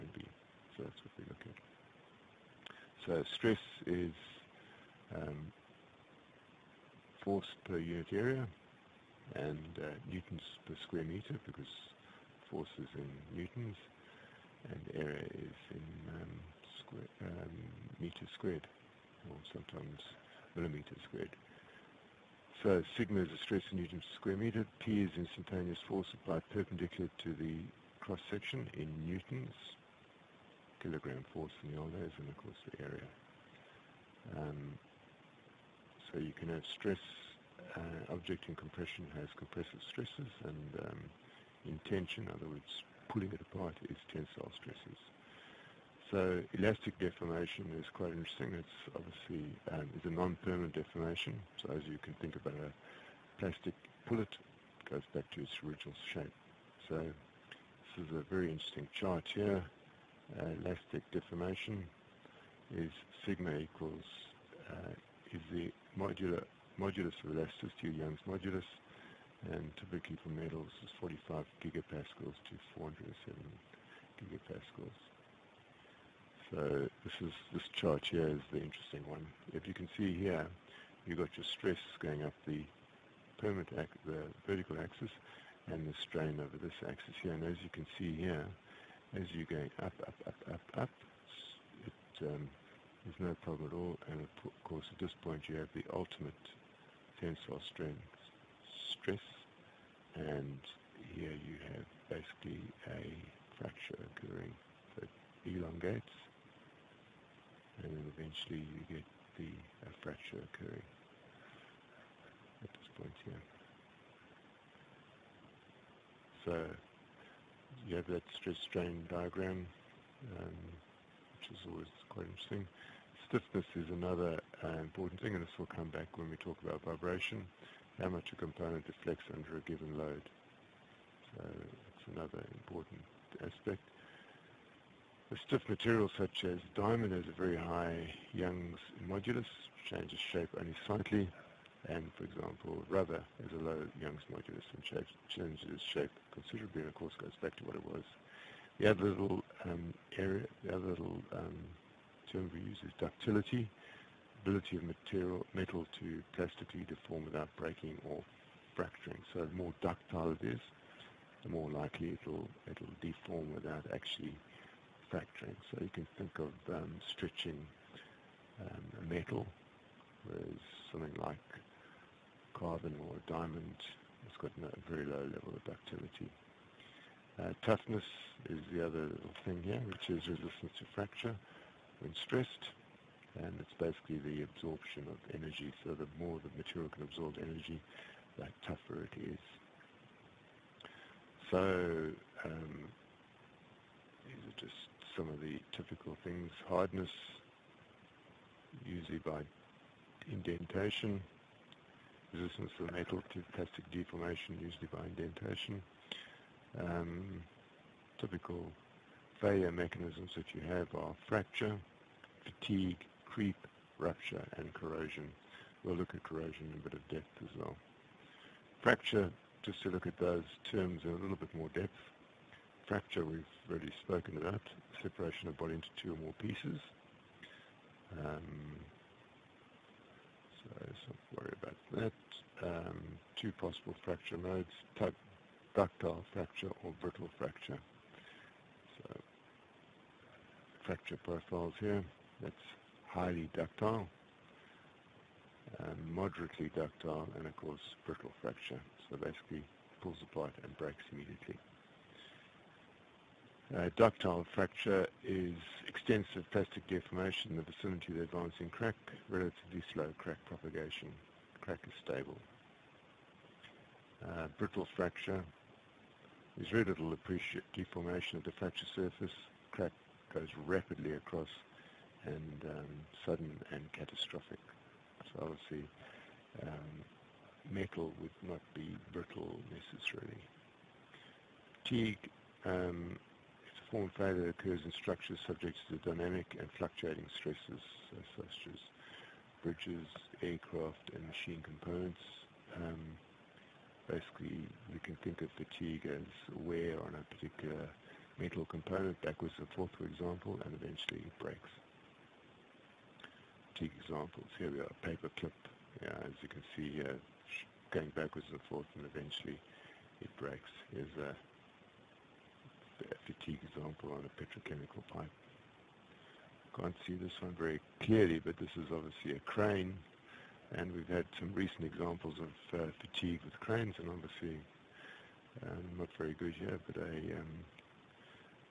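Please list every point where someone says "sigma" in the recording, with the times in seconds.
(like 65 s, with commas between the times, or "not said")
22 s, 63 s.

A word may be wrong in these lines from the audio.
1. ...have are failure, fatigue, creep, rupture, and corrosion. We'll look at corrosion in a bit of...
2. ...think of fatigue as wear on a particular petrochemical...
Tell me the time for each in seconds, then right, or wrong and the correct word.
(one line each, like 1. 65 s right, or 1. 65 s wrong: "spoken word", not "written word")
1. 210 s wrong: "fracture", not "failure"
2. 295 s wrong: "metal", not "petrochemical".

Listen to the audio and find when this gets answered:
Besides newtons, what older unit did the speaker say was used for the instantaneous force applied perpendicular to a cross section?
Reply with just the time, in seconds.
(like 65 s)
30 s.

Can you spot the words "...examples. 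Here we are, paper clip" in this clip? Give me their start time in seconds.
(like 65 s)
304 s.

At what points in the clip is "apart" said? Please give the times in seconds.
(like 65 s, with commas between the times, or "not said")
43 s, 250 s.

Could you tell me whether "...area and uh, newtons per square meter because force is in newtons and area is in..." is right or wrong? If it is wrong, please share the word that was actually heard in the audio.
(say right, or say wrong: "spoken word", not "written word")
right.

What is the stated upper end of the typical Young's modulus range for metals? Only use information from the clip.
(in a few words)
407 gigapascals.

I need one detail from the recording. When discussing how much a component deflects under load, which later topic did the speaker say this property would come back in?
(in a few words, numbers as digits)
vibration.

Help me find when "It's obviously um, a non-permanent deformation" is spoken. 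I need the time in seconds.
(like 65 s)
48 s.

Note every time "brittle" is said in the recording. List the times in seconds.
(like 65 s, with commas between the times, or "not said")
237 s, 248 s, 264 s, 279 s.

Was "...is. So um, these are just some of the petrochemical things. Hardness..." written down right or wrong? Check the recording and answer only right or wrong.
wrong.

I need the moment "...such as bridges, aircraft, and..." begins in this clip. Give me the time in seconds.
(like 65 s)
288 s.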